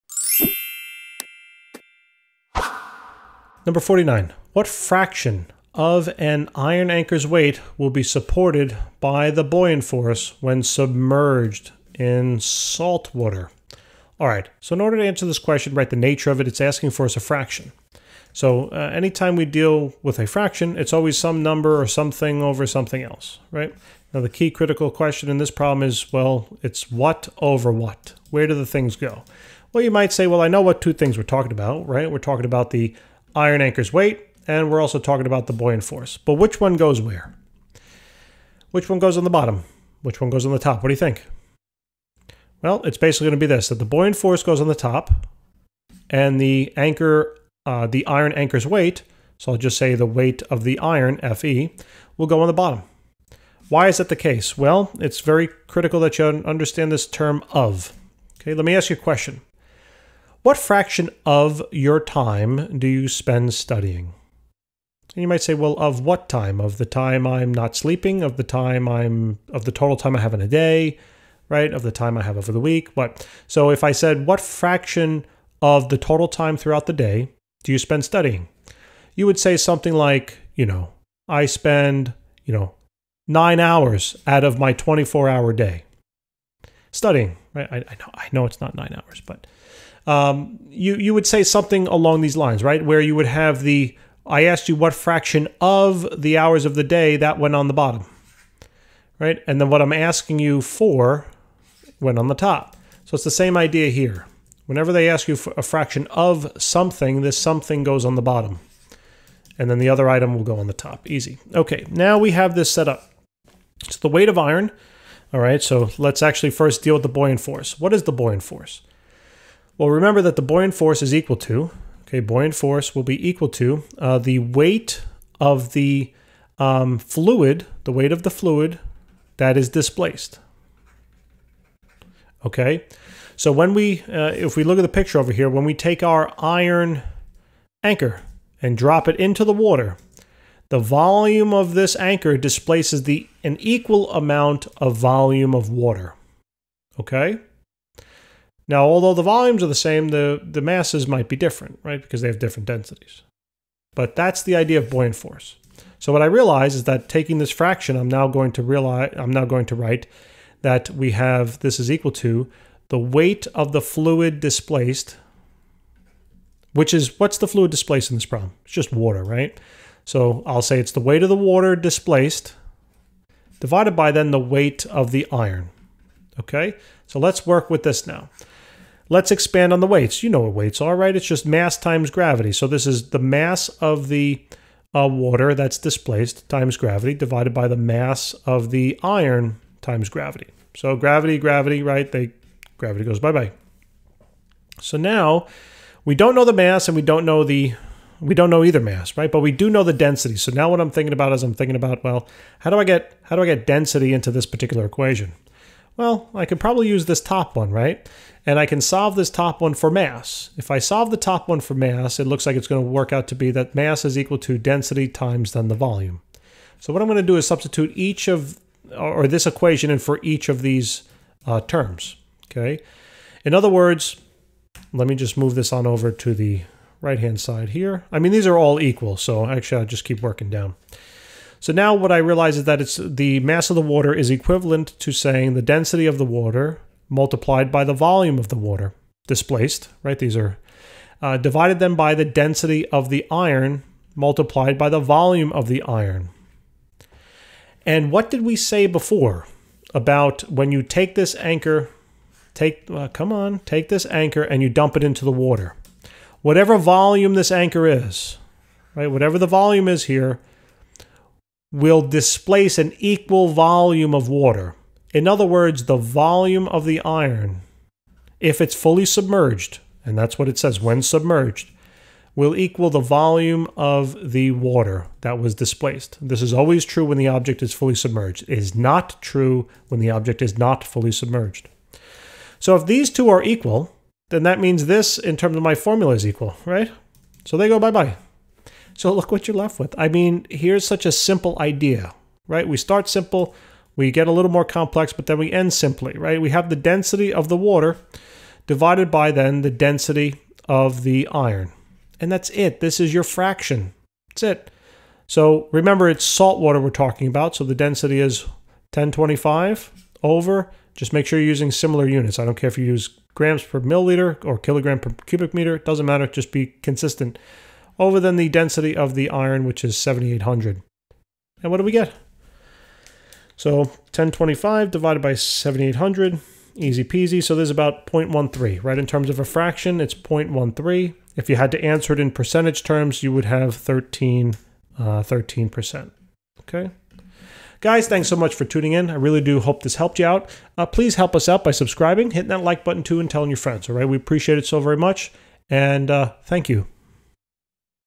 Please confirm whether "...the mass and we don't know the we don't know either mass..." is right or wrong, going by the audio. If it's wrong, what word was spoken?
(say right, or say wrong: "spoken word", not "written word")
right.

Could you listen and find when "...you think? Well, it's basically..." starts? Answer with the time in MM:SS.
00:40.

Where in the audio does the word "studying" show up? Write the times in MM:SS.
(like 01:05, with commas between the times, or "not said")
01:03, 01:18, 01:26.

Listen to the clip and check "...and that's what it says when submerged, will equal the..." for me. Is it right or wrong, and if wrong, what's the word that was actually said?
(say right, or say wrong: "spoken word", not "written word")
right.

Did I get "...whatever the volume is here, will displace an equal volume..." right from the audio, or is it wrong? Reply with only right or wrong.
right.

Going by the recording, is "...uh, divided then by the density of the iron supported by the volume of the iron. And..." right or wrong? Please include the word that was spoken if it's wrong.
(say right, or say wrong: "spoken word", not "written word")
wrong: "multiplied", not "supported".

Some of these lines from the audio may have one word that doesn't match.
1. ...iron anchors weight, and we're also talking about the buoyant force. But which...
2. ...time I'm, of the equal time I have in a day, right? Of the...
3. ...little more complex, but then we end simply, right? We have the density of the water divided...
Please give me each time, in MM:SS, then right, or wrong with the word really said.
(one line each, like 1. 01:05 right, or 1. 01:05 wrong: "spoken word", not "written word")
1. 00:33 right
2. 01:08 wrong: "total", not "equal"
3. 04:54 right.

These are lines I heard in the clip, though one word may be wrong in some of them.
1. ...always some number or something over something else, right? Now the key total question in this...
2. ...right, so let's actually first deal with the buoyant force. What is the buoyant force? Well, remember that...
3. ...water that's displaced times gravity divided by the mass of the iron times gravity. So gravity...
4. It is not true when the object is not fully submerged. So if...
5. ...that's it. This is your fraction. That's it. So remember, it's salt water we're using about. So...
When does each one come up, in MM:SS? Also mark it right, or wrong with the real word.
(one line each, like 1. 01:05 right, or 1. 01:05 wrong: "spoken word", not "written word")
1. 00:20 wrong: "critical", not "total"
2. 01:55 right
3. 03:05 right
4. 04:38 right
5. 05:02 wrong: "talking", not "using".